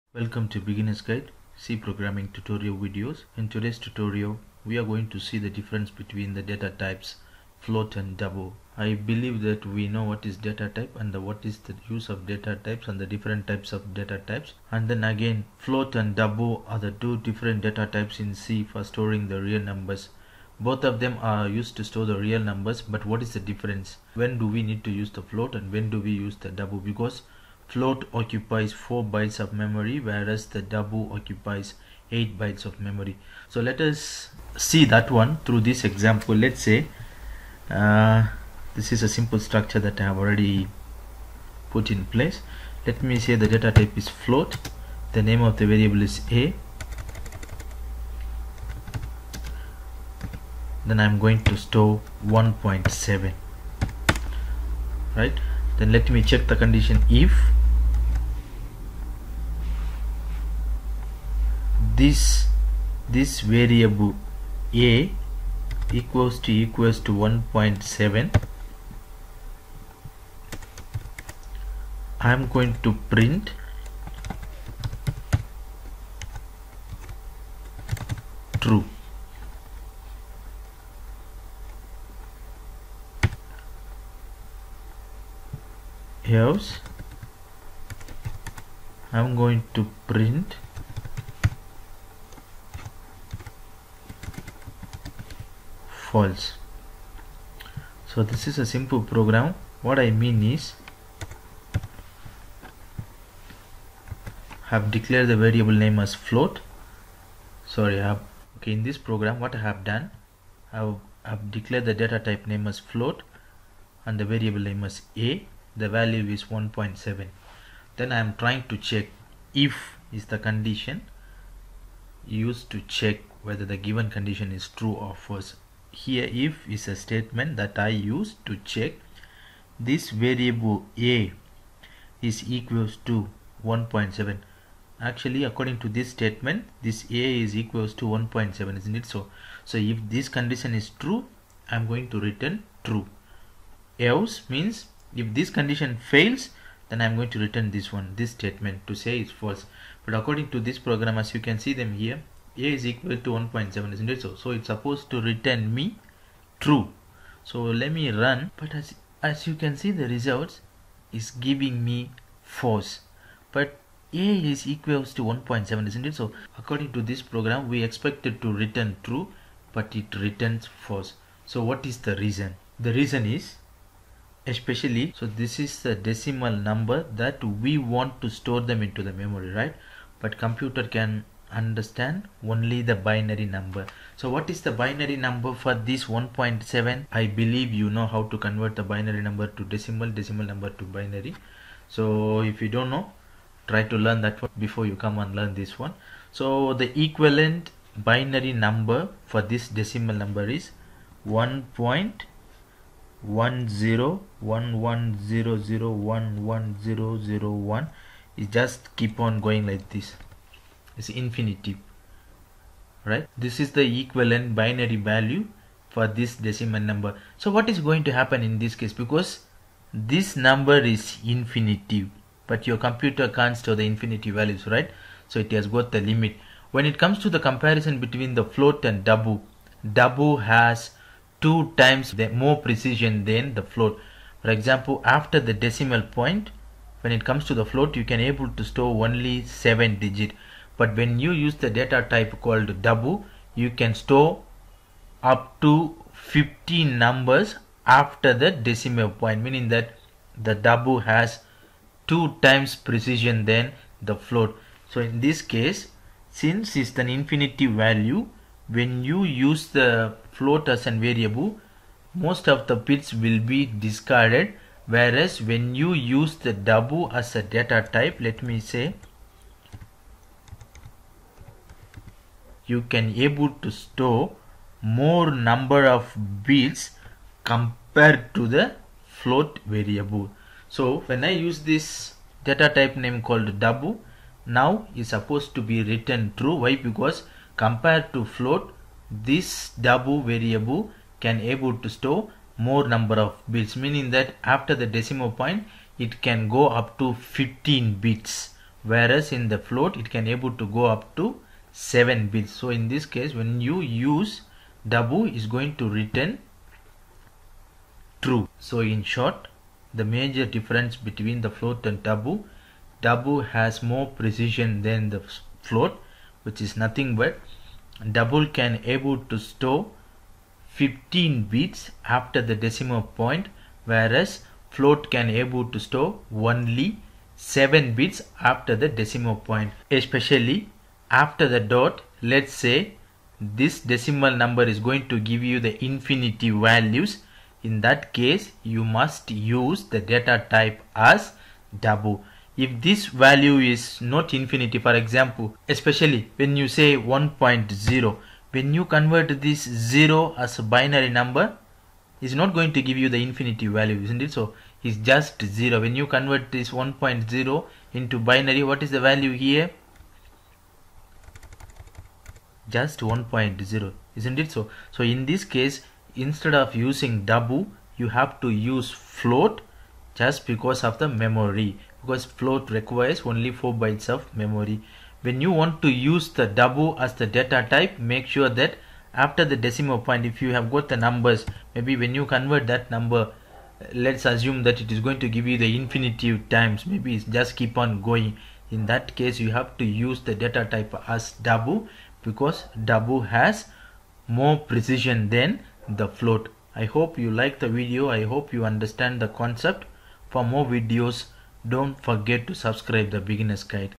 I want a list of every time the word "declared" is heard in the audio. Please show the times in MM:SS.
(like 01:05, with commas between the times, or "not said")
01:44, 01:51.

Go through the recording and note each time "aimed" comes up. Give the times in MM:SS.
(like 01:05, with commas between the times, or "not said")
not said.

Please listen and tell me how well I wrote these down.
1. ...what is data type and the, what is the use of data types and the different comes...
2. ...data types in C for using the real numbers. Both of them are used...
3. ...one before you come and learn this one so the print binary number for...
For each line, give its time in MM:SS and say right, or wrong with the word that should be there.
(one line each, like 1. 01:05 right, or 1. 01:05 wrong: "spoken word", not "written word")
1. 00:10 wrong: "types", not "comes"
2. 00:17 wrong: "storing", not "using"
3. 03:14 wrong: "equivalent", not "print".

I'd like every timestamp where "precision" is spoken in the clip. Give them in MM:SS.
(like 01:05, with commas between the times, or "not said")
03:52, 04:12, 05:14, 06:34.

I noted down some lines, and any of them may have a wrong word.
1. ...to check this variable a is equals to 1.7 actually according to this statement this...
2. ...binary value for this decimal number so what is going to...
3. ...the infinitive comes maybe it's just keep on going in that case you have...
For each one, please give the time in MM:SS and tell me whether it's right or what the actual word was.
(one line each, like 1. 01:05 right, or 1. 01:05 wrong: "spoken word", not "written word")
1. 02:08 right
2. 03:34 right
3. 06:25 wrong: "times", not "comes".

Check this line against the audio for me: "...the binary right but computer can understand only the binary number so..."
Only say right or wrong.
wrong.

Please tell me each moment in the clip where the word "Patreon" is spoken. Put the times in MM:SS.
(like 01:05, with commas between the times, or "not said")
not said.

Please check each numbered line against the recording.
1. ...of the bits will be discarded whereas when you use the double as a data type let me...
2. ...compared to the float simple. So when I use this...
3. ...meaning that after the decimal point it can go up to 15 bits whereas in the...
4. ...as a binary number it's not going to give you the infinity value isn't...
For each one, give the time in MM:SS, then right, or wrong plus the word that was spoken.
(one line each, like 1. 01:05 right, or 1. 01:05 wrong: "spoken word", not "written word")
1. 04:22 right
2. 04:37 wrong: "variable", not "simple"
3. 04:53 right
4. 05:50 right.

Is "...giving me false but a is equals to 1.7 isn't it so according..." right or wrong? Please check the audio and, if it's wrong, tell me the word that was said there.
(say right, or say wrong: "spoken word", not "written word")
right.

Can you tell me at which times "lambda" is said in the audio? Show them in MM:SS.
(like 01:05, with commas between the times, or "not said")
not said.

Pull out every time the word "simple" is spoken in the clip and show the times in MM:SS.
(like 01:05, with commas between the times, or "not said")
00:39, 01:38.